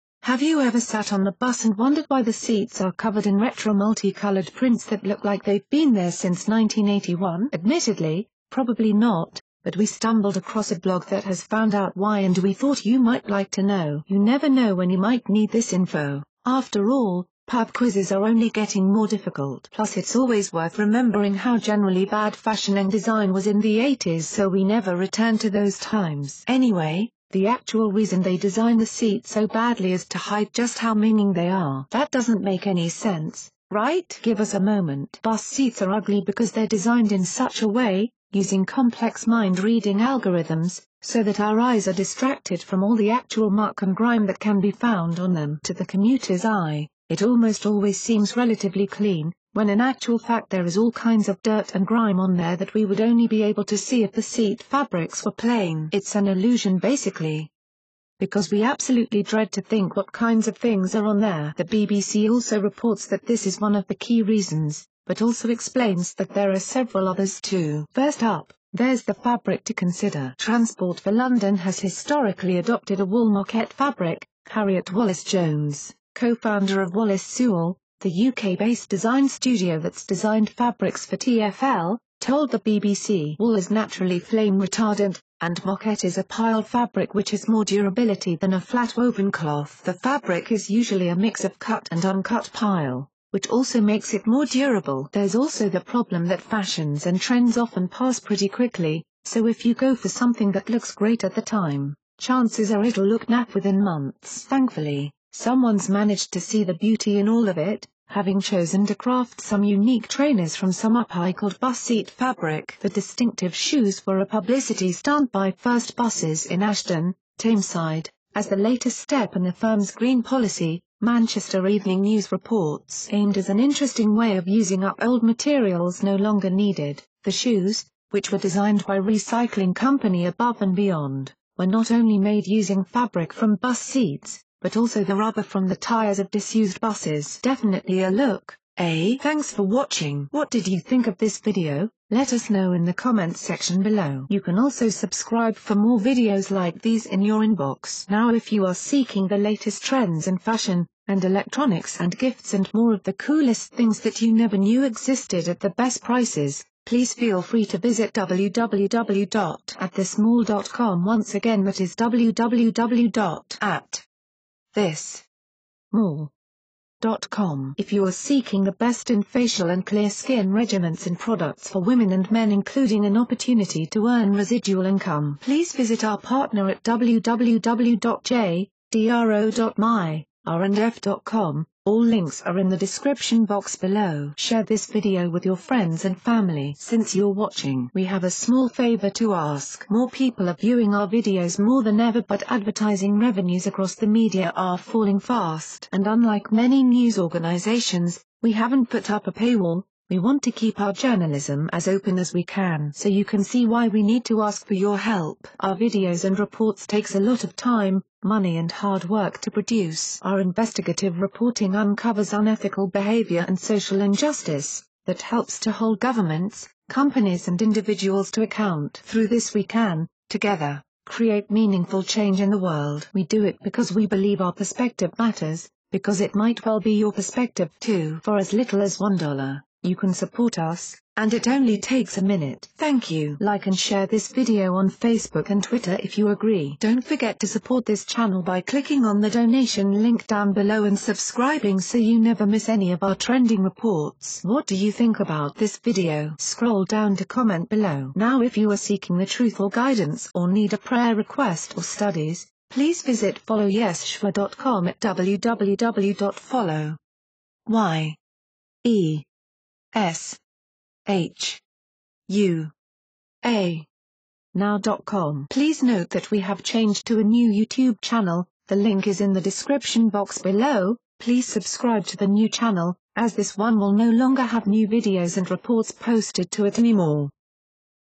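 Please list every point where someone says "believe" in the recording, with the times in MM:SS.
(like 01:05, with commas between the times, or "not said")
03:44.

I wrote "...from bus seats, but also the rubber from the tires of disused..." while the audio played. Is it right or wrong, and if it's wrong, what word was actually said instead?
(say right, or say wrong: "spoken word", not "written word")
right.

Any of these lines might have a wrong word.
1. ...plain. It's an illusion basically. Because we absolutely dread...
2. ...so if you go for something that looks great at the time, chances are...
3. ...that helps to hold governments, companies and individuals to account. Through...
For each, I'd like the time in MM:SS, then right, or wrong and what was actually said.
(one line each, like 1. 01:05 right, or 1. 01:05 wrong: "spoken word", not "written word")
1. 00:55 right
2. 01:39 right
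3. 03:35 right.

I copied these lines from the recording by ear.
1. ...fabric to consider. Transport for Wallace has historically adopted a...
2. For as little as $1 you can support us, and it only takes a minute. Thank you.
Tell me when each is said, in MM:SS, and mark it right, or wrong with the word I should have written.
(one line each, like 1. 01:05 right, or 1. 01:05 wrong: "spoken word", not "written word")
1. 01:09 wrong: "London", not "Wallace"
2. 03:48 right.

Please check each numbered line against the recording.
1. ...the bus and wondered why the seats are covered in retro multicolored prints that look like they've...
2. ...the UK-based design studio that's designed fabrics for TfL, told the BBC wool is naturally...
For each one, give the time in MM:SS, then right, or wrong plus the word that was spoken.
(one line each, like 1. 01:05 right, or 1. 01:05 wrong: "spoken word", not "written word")
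1. 00:01 right
2. 01:18 right.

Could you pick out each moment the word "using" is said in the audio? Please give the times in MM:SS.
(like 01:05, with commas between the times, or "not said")
00:38, 02:04, 02:12.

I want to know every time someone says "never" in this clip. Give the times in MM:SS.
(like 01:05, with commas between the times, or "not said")
00:14, 00:24, 02:34, 04:02.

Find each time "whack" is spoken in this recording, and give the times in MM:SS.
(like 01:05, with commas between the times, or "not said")
not said.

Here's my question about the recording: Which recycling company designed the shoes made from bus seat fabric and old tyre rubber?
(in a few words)
Above and Beyond.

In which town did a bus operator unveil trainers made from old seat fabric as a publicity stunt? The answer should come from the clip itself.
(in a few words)
Ashton.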